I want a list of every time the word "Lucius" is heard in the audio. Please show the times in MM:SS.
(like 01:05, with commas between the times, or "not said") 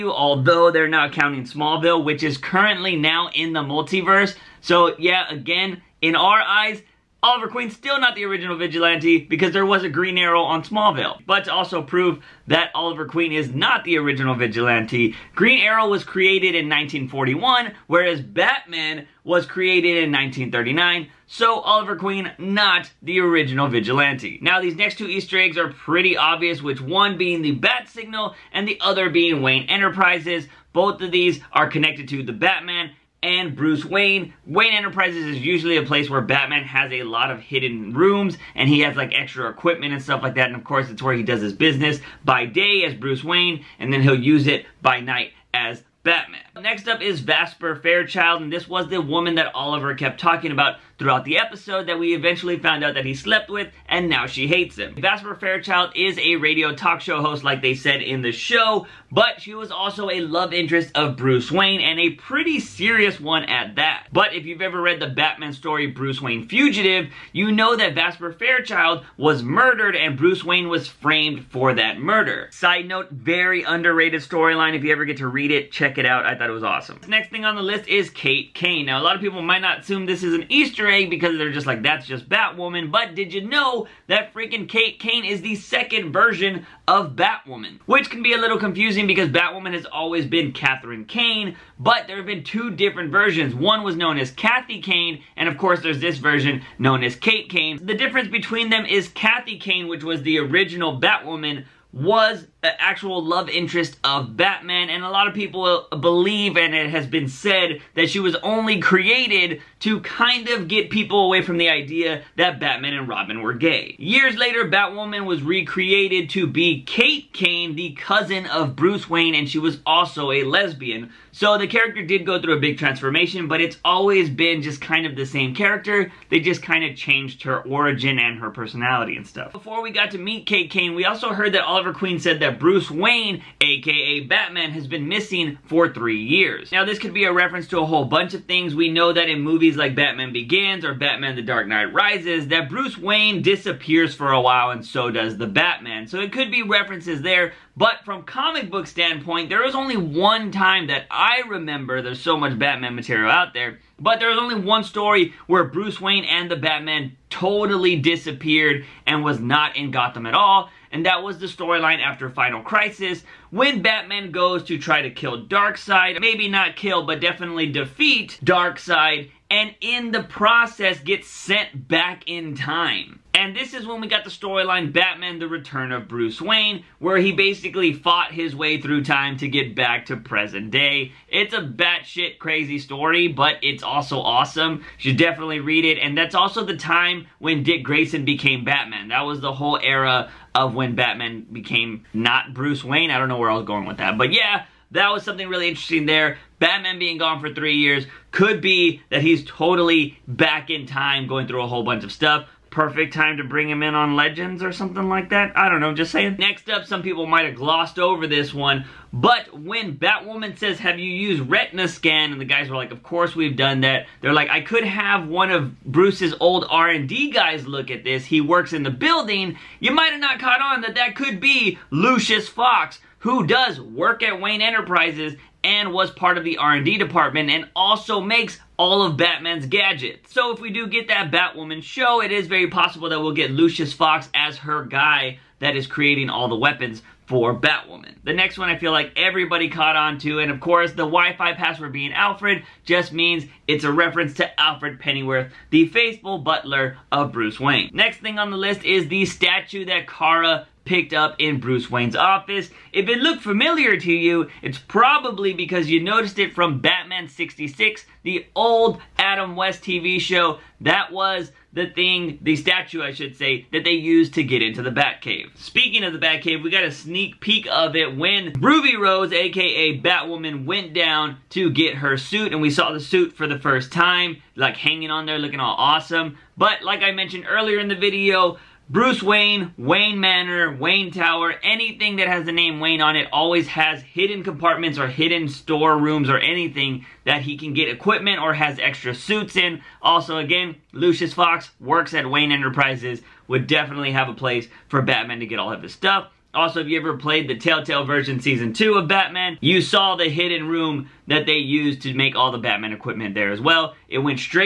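03:41, 03:53, 04:50.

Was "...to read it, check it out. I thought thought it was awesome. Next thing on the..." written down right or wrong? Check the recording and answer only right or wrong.
right.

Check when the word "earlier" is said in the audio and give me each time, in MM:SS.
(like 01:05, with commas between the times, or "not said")
04:37.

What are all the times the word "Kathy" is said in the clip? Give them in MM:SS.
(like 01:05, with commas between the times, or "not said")
01:34, 01:39.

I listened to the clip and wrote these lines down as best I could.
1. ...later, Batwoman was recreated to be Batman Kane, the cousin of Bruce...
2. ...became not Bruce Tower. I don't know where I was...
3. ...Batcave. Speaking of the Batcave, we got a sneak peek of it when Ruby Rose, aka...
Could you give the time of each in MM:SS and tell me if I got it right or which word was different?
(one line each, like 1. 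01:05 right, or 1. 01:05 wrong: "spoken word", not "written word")
1. 01:54 wrong: "Kate", not "Batman"
2. 03:11 wrong: "Wayne", not "Tower"
3. 04:24 right.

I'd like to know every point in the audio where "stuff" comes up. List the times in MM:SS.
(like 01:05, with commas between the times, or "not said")
00:40, 02:09, 03:22, 04:55.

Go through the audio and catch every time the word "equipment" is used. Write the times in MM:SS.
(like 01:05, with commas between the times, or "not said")
00:39, 04:47, 05:02.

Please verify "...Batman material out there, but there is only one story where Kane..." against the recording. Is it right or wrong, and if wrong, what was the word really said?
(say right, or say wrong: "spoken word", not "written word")
wrong: "Bruce", not "Kane".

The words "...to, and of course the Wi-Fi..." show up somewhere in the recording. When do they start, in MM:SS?
04:00.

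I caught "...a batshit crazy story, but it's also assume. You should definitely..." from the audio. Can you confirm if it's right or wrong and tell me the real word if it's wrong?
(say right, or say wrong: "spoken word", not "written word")
wrong: "awesome", not "assume".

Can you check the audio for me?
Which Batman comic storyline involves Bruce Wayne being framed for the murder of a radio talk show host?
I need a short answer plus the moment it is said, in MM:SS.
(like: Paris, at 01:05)
Bruce Wayne Fugitive, at 01:05.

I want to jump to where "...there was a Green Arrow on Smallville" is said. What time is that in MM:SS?
00:09.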